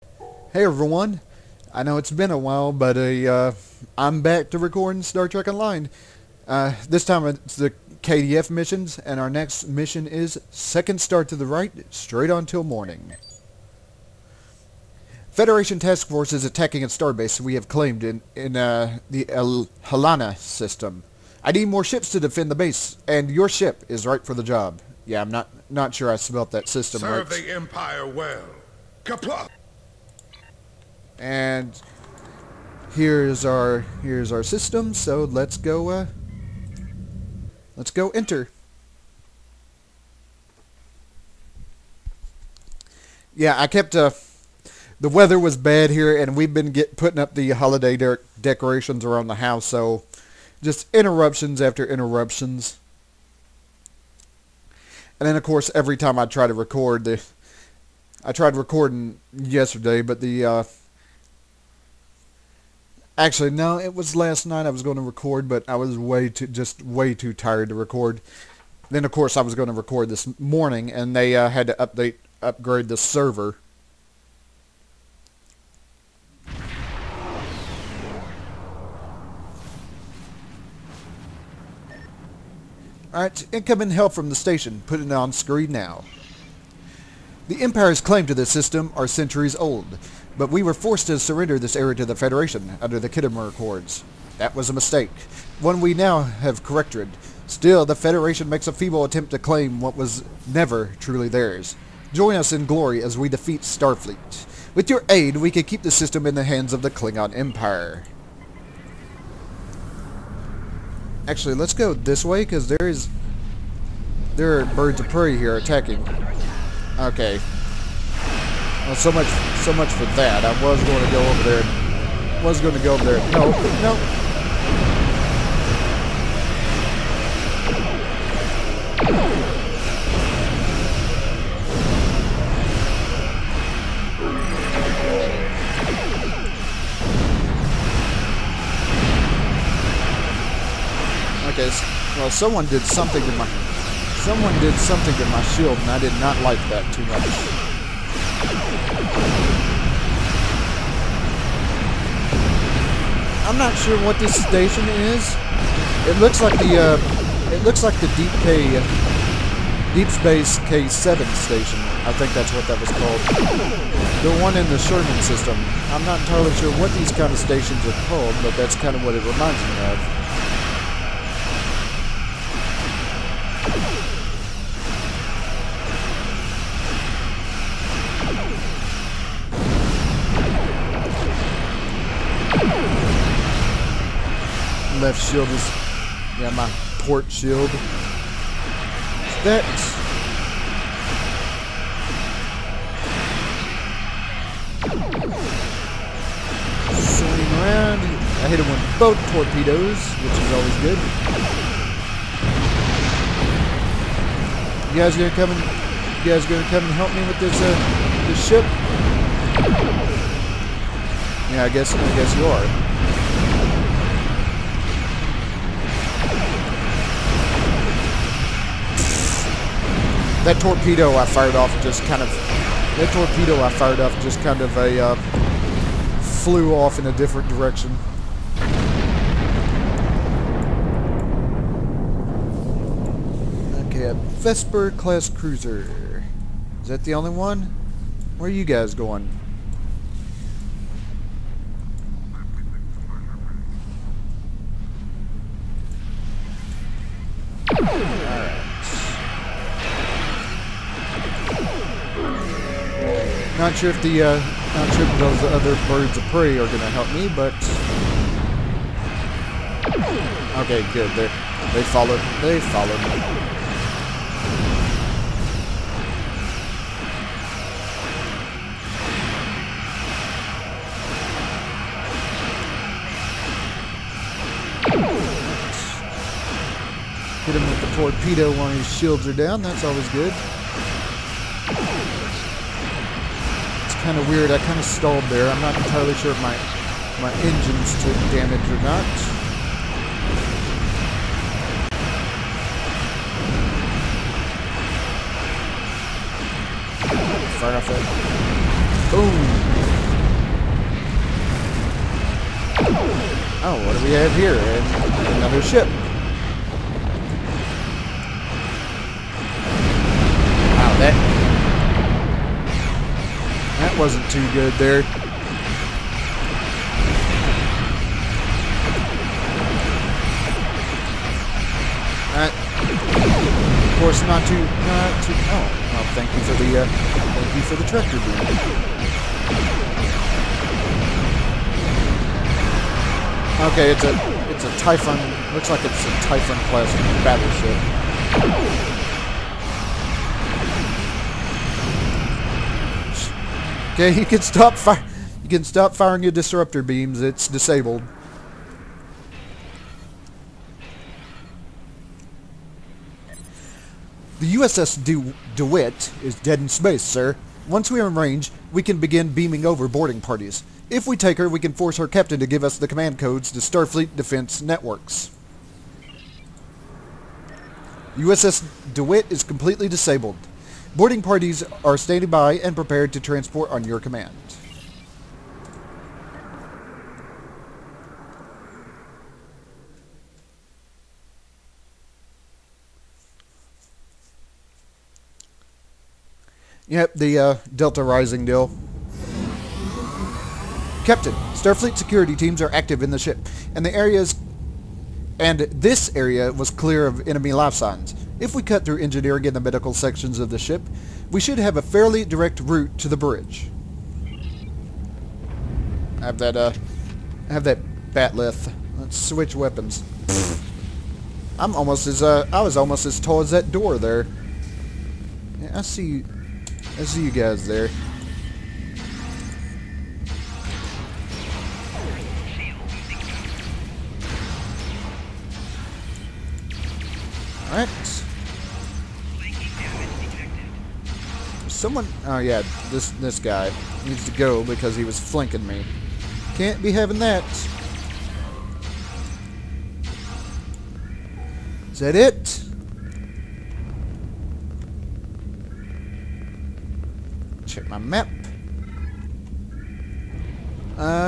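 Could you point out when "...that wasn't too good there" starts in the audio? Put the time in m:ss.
5:10.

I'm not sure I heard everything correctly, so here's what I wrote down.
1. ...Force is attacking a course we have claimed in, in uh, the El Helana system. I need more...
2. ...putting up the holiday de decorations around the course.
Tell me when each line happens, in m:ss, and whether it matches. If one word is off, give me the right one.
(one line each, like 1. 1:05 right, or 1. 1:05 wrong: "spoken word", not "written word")
1. 0:16 wrong: "starbase", not "course"
2. 0:46 wrong: "house", not "course".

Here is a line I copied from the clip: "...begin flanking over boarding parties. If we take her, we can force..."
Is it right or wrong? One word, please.
wrong.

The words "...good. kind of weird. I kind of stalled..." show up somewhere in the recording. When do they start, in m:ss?
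4:40.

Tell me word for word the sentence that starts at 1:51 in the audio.
Actually, let's go this way, because there is...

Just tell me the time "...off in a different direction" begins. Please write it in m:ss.
3:46.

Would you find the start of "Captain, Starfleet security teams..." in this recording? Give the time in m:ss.
6:31.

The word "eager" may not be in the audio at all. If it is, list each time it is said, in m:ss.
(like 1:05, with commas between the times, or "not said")
not said.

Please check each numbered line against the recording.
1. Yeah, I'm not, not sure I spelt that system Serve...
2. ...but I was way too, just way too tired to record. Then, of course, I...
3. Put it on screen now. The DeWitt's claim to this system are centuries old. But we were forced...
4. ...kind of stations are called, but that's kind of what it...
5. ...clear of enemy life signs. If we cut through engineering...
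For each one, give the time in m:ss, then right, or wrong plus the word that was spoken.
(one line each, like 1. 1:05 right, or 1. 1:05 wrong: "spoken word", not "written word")
1. 0:25 right
2. 1:05 right
3. 1:24 wrong: "Empire", not "DeWitt"
4. 2:47 right
5. 6:36 right.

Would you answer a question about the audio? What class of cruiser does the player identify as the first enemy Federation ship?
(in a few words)
Vesper class.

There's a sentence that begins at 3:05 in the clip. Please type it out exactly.
left shield is, yeah, my port shield.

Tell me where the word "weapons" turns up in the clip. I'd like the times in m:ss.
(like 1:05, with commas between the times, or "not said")
6:49.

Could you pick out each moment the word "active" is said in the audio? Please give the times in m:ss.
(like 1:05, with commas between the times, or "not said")
6:32.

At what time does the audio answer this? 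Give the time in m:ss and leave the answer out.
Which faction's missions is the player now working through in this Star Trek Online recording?
0:08.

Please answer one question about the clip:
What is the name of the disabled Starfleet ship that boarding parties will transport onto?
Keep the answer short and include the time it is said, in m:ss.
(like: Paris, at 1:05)
USS DeWitt, at 6:08.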